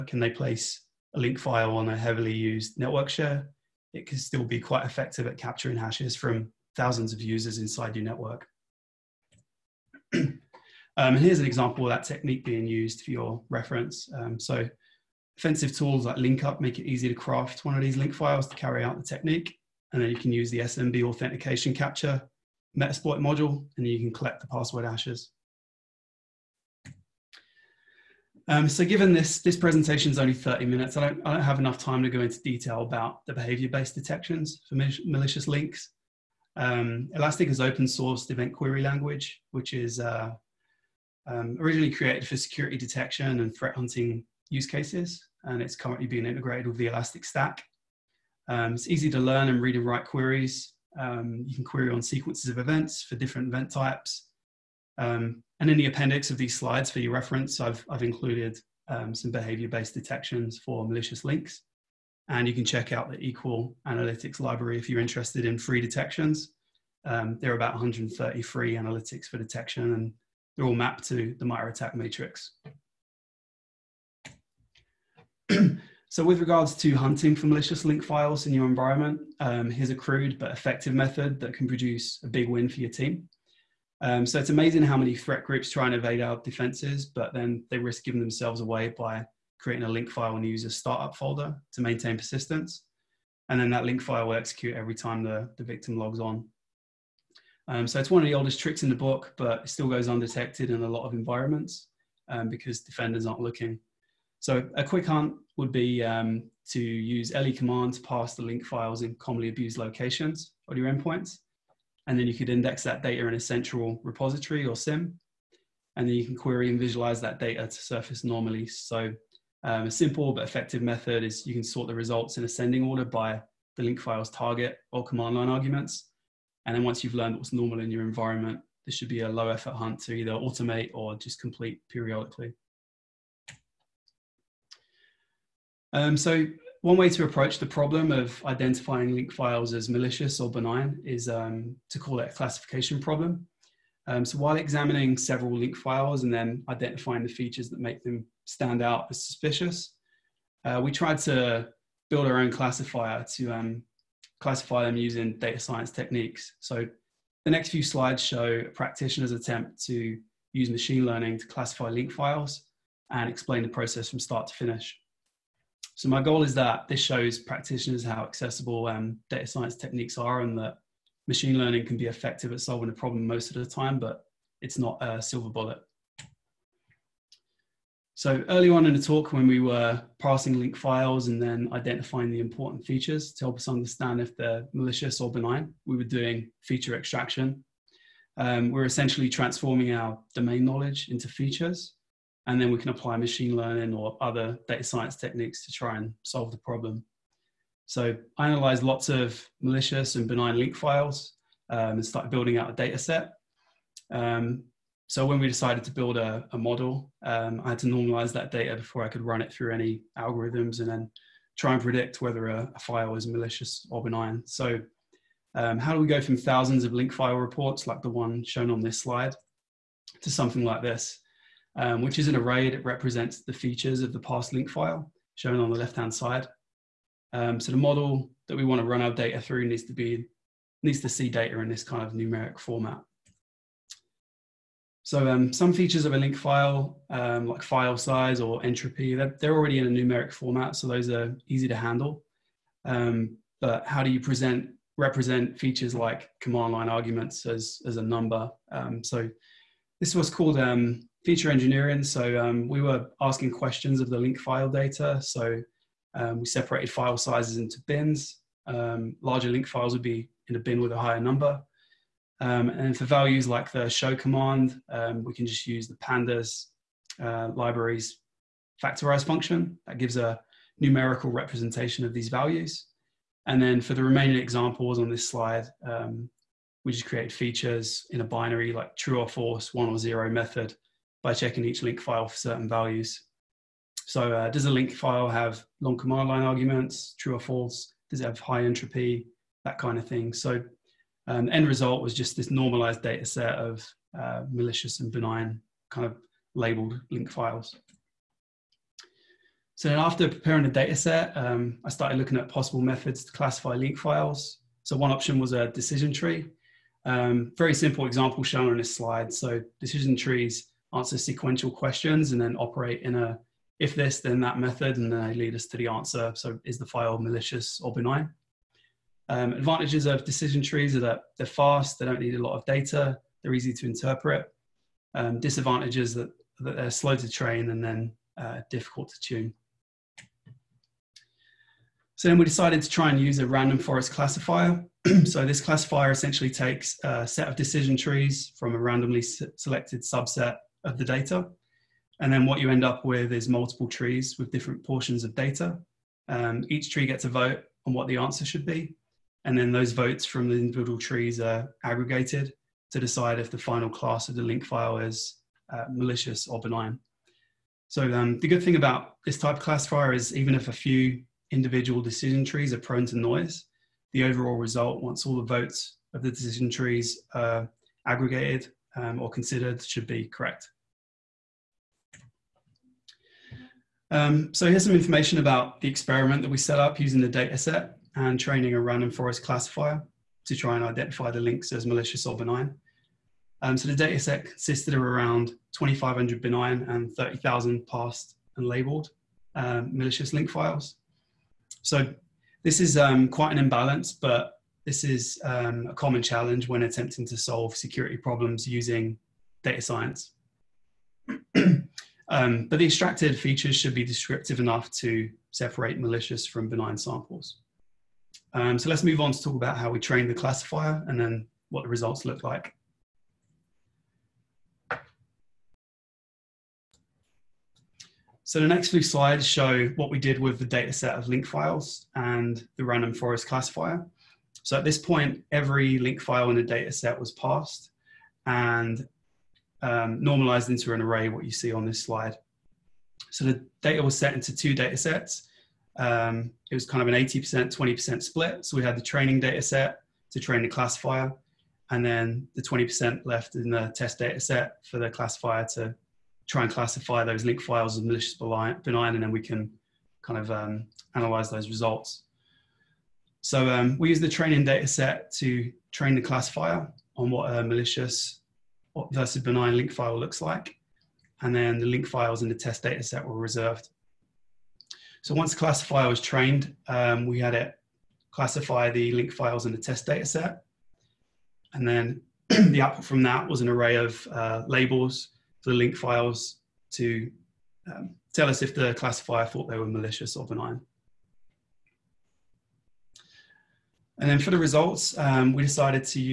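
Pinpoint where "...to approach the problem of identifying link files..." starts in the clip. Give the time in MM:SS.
02:17.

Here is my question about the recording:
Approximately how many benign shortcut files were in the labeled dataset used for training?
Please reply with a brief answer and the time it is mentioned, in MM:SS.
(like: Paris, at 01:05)
2,500, at 06:25.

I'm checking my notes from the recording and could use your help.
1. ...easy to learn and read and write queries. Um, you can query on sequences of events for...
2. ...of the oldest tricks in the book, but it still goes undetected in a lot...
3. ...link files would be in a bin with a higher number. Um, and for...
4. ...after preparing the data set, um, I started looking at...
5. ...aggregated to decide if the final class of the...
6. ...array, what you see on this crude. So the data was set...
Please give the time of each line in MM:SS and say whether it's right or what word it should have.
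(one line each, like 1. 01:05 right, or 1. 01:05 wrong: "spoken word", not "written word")
1. 00:48 right
2. 01:38 right
3. 04:19 right
4. 04:59 right
5. 05:51 right
6. 07:10 wrong: "slide", not "crude".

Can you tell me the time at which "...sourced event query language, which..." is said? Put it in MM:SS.
00:37.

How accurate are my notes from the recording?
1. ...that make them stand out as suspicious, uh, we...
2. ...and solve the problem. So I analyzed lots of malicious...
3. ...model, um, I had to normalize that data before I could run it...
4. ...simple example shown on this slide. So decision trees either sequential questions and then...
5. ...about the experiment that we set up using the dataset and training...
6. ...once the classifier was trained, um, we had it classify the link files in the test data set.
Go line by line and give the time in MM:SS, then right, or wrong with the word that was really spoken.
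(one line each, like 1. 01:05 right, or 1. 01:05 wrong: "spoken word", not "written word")
1. 02:27 right
2. 03:15 right
3. 03:26 right
4. 05:07 wrong: "answer", not "either"
5. 06:15 right
6. 07:45 right.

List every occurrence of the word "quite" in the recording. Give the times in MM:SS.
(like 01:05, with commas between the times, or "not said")
00:04, 06:33.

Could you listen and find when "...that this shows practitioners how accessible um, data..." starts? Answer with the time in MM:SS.
02:46.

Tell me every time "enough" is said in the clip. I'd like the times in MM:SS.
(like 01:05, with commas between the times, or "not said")
00:31, 06:44.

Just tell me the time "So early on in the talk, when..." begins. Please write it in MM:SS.
02:58.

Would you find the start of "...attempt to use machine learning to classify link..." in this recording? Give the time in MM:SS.
02:39.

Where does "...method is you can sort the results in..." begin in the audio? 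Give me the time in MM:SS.
02:00.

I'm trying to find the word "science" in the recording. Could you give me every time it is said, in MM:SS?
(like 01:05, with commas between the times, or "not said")
02:35, 02:49, 03:14, 06:39.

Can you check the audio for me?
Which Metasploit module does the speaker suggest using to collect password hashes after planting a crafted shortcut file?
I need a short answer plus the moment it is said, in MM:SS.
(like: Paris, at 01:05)
SMB authentication capture, at 00:20.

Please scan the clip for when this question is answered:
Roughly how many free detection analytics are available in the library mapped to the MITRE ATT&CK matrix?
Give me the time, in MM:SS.
01:07.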